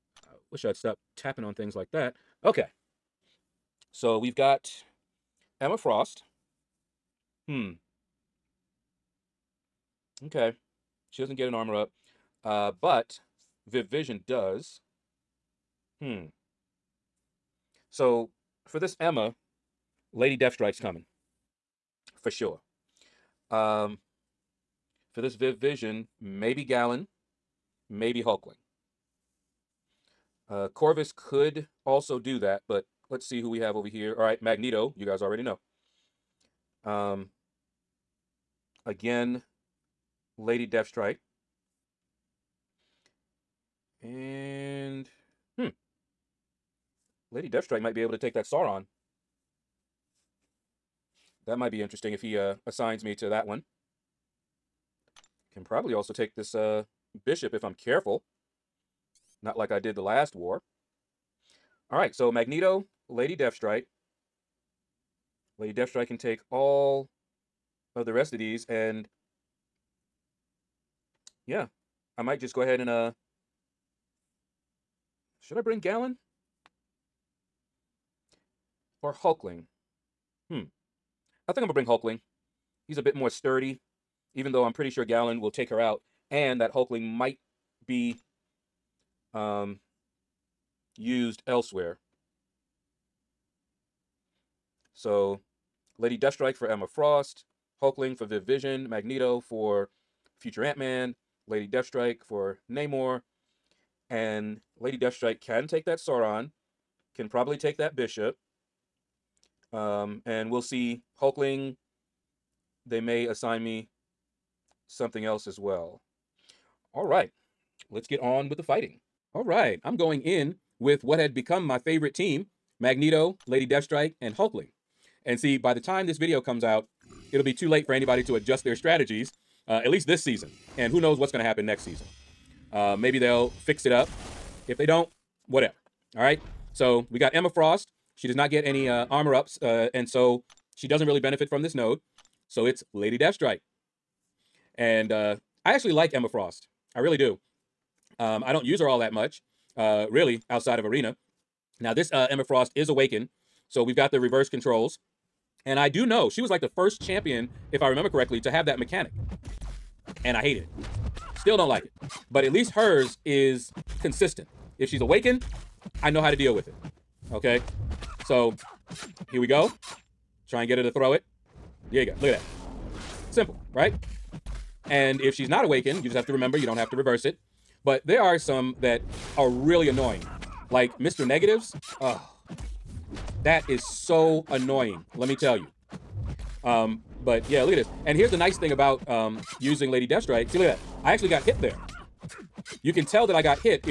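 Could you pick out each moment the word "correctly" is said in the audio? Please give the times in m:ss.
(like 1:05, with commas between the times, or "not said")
2:38.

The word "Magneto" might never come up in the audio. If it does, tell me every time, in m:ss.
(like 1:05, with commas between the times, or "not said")
0:34, 1:02, 1:38, 2:02.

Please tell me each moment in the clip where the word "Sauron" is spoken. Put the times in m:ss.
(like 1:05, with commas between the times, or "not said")
0:48, 1:45.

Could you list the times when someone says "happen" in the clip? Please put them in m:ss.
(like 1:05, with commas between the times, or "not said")
2:11.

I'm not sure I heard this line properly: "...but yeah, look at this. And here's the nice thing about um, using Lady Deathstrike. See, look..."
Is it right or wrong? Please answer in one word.
right.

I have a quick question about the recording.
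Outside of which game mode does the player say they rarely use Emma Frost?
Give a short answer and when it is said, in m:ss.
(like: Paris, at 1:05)
Arena, at 2:30.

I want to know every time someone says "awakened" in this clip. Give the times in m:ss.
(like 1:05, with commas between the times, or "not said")
2:32, 2:45, 2:55.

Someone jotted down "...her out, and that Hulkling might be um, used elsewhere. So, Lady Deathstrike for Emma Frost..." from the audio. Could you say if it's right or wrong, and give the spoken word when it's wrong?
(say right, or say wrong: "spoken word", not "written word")
right.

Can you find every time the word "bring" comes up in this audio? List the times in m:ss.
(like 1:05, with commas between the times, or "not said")
1:15, 1:21.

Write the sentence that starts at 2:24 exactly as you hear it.
And uh, I actually like Emma Frost.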